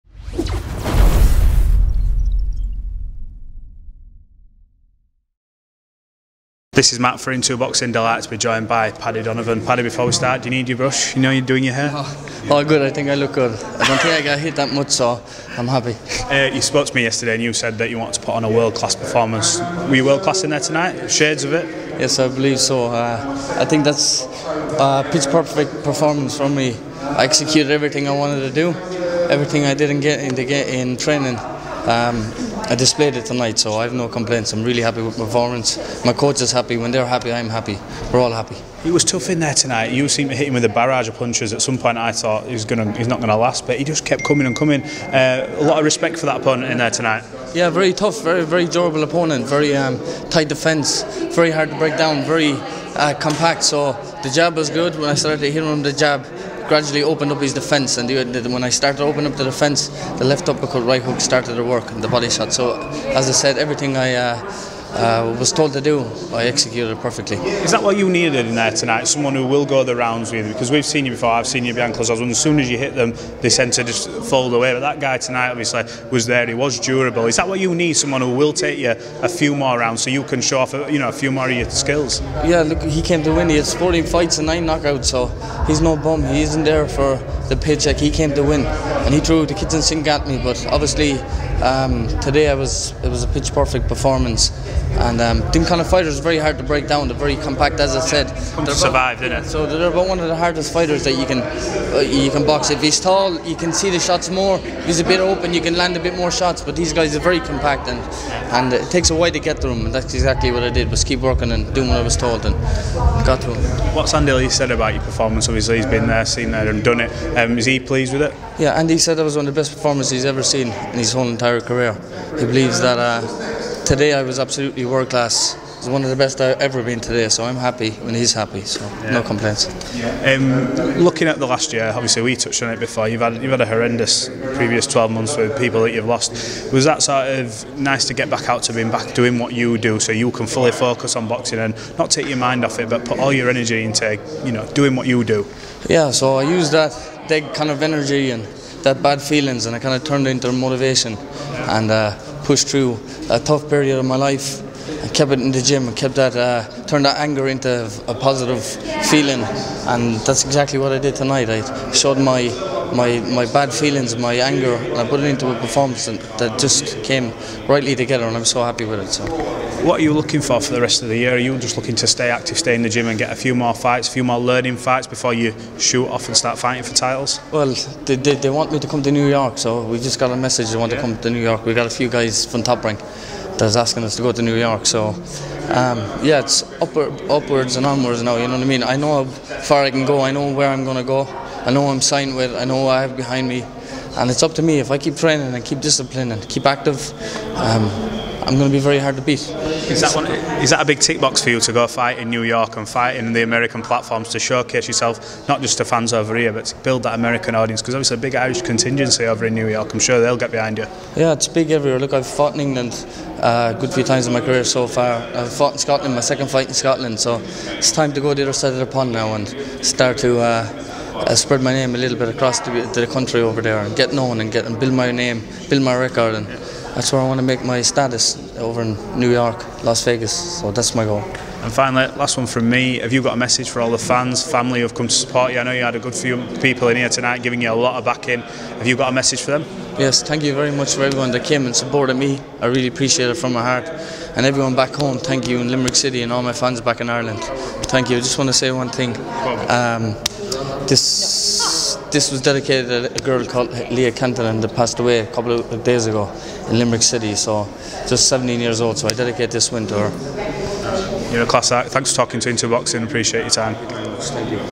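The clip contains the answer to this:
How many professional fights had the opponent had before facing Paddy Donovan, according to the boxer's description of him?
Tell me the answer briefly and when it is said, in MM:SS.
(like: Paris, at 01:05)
14, at 01:23.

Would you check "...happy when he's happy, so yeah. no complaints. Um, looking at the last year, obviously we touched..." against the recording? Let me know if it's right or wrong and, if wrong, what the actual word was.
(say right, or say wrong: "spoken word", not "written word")
right.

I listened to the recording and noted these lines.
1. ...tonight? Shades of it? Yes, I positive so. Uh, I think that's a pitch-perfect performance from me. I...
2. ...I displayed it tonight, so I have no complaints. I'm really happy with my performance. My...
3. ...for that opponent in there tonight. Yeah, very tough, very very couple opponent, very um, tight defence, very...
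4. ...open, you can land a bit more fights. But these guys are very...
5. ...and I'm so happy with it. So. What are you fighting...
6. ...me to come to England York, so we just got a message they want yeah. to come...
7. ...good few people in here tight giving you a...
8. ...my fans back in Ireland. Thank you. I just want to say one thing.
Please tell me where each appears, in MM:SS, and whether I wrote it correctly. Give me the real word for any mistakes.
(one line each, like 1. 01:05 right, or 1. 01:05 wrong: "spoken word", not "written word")
1. 00:20 wrong: "believe", not "positive"
2. 00:32 right
3. 00:46 wrong: "durable", not "couple"
4. 01:45 wrong: "shots", not "fights"
5. 02:48 wrong: "looking", not "fighting"
6. 02:58 wrong: "New", not "England"
7. 03:55 wrong: "tonight", not "tight"
8. 04:06 right.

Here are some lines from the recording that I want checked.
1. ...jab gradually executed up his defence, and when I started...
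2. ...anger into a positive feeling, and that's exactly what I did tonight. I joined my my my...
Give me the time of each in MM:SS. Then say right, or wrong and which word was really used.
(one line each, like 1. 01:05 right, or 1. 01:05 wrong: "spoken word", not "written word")
1. 00:55 wrong: "opened", not "executed"
2. 02:37 wrong: "showed", not "joined".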